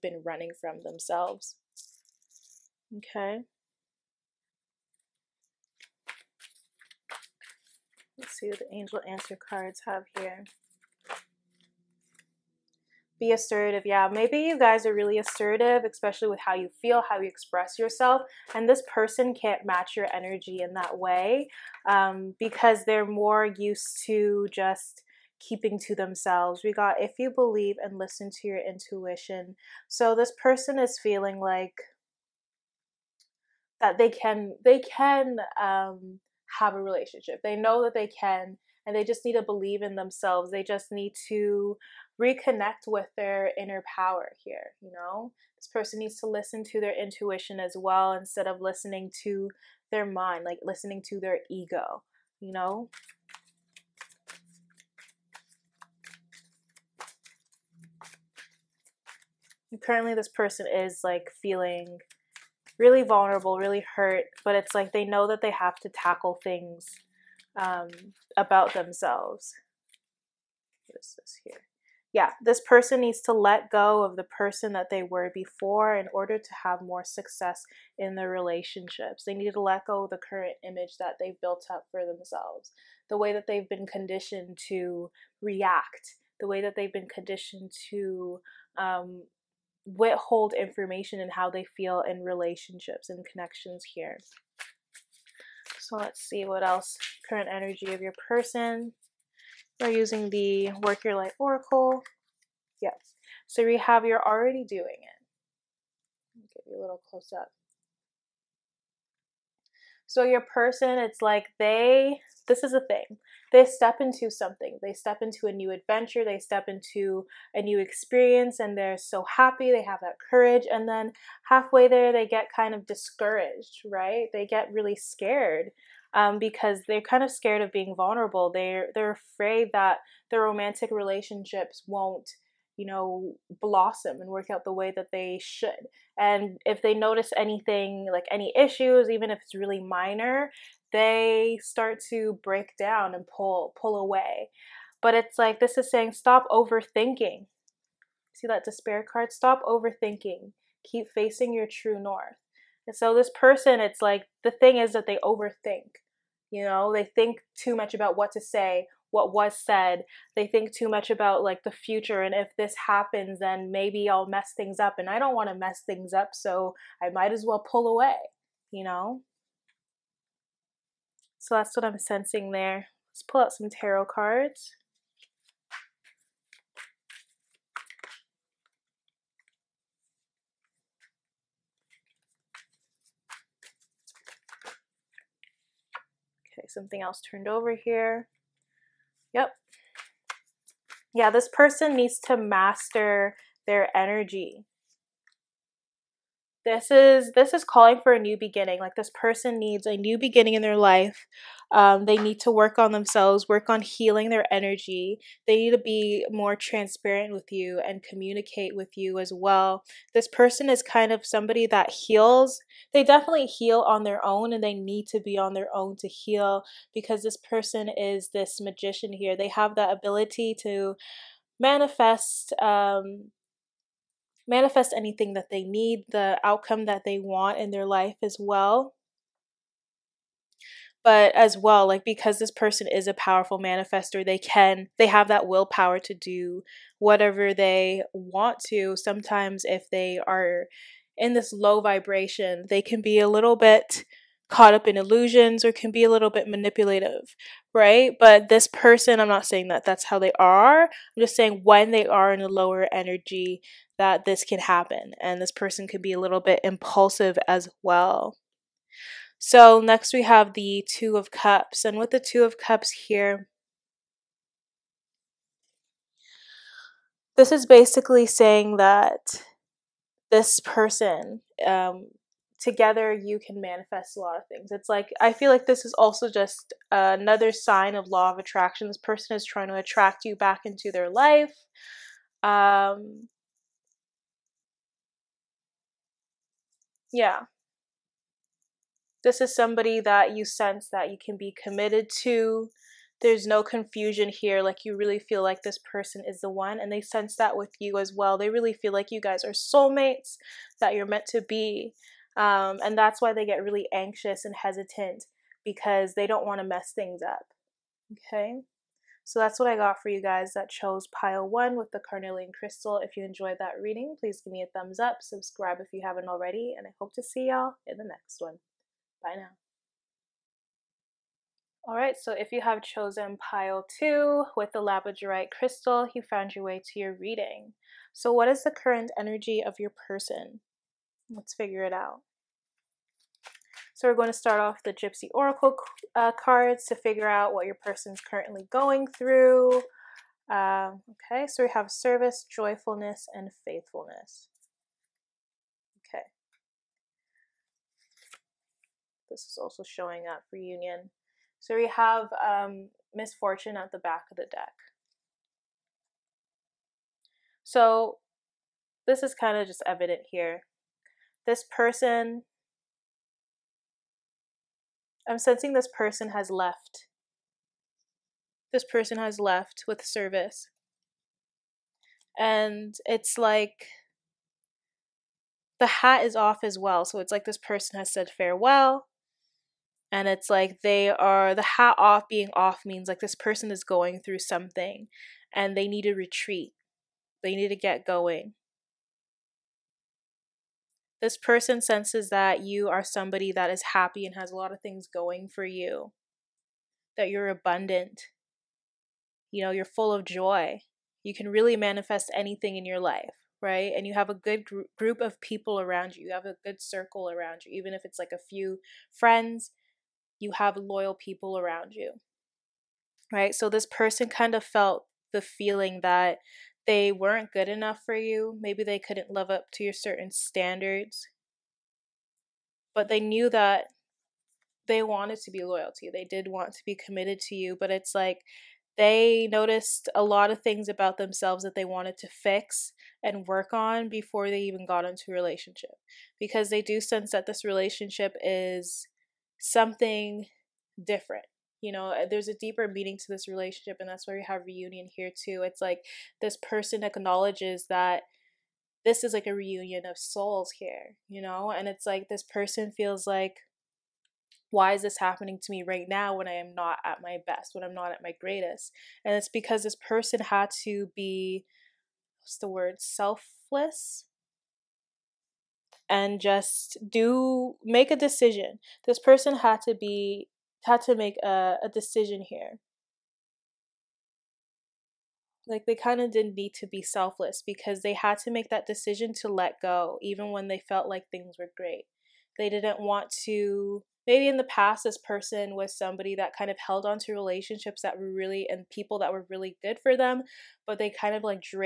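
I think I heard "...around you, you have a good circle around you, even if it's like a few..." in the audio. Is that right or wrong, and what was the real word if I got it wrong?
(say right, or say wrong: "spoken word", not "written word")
right.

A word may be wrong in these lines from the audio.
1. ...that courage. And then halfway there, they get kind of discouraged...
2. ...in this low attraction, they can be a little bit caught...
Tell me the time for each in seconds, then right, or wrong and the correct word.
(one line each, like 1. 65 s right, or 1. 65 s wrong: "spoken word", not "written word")
1. 120 s right
2. 241 s wrong: "vibration", not "attraction".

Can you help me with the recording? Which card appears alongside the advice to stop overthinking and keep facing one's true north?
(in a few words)
Despair.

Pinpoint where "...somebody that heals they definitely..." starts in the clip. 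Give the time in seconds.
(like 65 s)
211 s.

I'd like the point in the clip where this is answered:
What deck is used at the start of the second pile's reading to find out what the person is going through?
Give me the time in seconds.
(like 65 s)
334 s.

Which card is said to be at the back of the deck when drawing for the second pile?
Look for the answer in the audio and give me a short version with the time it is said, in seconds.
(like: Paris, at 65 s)
Misfortune, at 353 s.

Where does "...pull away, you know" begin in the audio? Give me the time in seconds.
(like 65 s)
167 s.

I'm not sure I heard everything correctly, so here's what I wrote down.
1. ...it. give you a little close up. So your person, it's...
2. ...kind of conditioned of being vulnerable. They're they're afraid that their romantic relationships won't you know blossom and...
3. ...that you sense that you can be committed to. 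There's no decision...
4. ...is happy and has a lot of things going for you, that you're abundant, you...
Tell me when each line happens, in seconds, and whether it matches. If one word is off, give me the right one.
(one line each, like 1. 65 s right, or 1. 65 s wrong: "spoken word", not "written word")
1. 105 s right
2. 127 s wrong: "scared", not "conditioned"
3. 290 s wrong: "confusion", not "decision"
4. 393 s right.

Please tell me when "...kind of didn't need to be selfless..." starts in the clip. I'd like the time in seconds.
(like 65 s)
475 s.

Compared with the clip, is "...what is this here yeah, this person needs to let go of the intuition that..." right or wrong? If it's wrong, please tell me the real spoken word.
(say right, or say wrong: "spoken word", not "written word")
wrong: "person", not "intuition".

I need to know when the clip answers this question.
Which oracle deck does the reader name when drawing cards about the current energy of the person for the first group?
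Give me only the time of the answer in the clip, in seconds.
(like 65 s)
100 s.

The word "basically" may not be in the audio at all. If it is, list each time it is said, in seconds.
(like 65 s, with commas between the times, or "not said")
267 s.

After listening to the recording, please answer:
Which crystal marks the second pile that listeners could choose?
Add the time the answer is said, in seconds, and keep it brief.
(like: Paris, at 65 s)
Labradorite, at 324 s.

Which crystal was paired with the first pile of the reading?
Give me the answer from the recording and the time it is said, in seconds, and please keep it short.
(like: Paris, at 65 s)
Carnelian, at 311 s.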